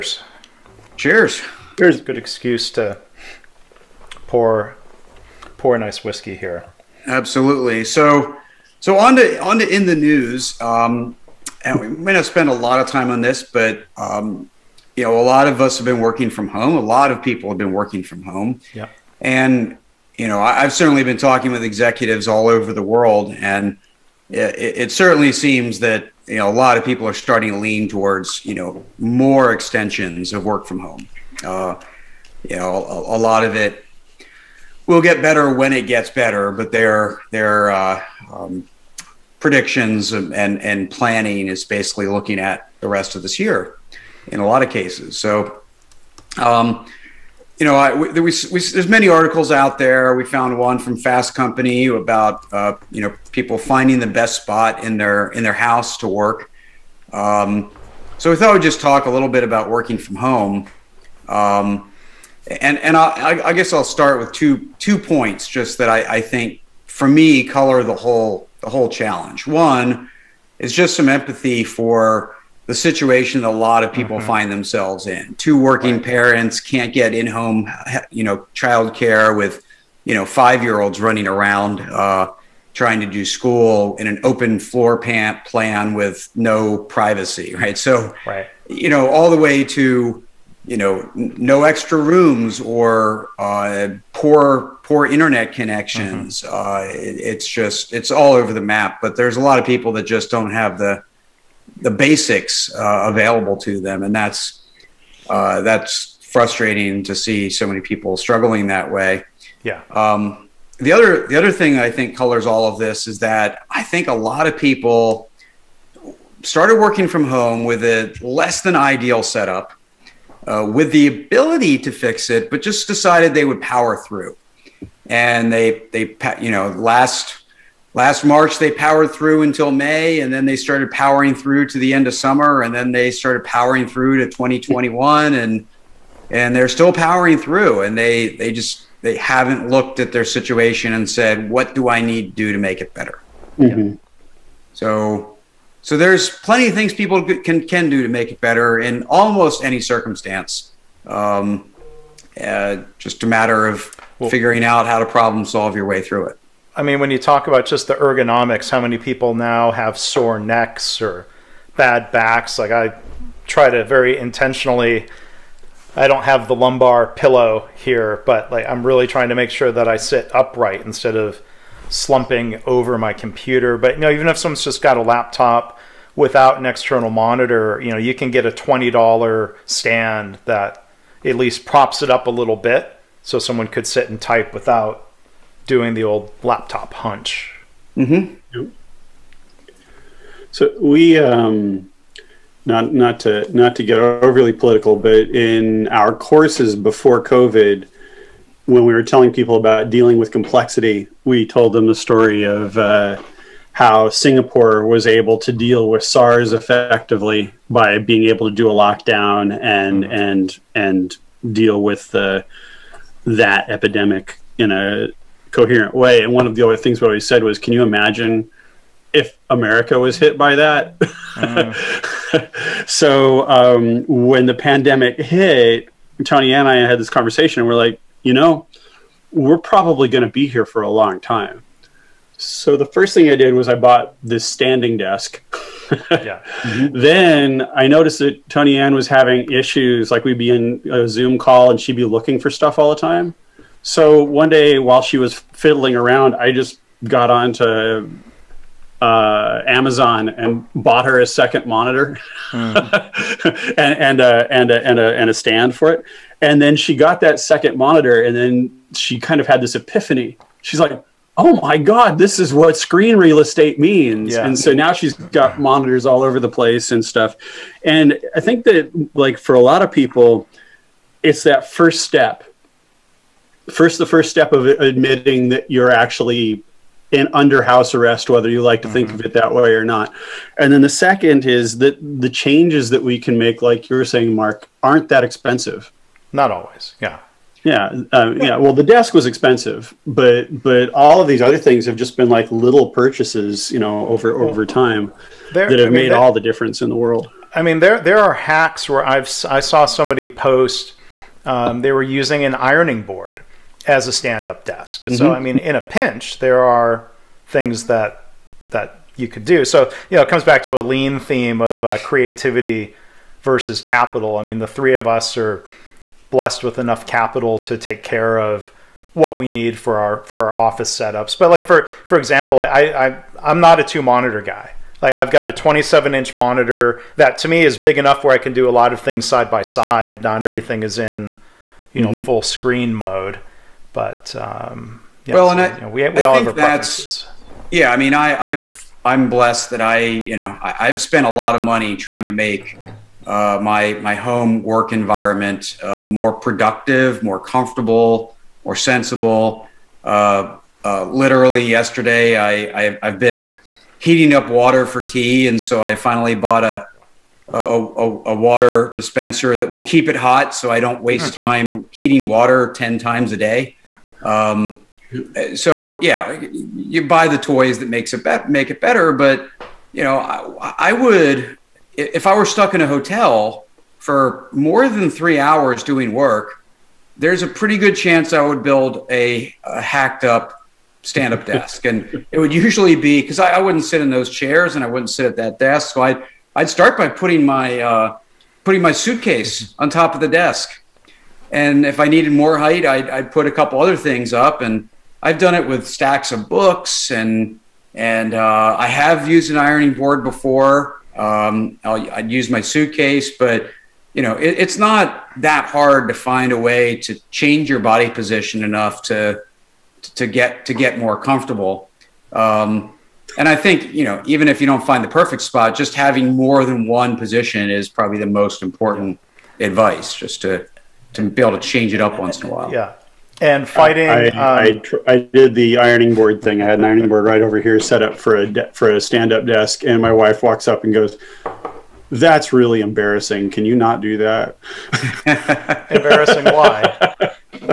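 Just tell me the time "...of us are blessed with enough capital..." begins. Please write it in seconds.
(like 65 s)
314 s.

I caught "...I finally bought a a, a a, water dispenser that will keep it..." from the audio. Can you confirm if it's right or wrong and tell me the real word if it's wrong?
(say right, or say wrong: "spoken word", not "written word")
right.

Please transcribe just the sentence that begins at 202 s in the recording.
Uh, how Singapore was able to deal with SARS effectively by being able to do a lockdown and mm-hmm.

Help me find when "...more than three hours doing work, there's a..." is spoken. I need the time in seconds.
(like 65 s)
374 s.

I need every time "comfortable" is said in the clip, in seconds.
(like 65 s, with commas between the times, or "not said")
347 s, 411 s.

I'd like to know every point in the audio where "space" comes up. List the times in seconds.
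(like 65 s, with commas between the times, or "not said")
not said.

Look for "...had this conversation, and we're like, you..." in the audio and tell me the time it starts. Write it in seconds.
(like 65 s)
226 s.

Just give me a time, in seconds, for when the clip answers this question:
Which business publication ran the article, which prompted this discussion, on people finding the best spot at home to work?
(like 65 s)
50 s.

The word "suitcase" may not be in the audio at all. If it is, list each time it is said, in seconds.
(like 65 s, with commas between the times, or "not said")
388 s, 402 s.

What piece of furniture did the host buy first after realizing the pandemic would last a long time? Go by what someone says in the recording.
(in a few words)
standing desk.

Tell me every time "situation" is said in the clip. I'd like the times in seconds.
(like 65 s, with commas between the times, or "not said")
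72 s, 140 s.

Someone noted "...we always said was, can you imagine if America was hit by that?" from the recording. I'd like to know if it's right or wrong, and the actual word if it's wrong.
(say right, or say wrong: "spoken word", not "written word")
right.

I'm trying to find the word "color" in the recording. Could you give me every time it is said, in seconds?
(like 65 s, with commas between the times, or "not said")
67 s, 112 s.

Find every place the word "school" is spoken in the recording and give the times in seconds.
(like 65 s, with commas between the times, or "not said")
83 s.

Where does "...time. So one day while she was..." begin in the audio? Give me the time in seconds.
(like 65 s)
242 s.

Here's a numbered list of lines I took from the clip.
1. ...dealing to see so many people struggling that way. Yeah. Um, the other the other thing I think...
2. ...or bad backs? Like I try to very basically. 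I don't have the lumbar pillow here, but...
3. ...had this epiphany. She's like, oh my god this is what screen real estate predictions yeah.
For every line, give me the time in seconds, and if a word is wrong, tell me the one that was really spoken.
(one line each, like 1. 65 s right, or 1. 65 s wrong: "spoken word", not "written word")
1. 106 s wrong: "frustrating", not "dealing"
2. 161 s wrong: "intentionally", not "basically"
3. 259 s wrong: "means", not "predictions".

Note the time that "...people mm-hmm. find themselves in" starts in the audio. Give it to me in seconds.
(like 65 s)
73 s.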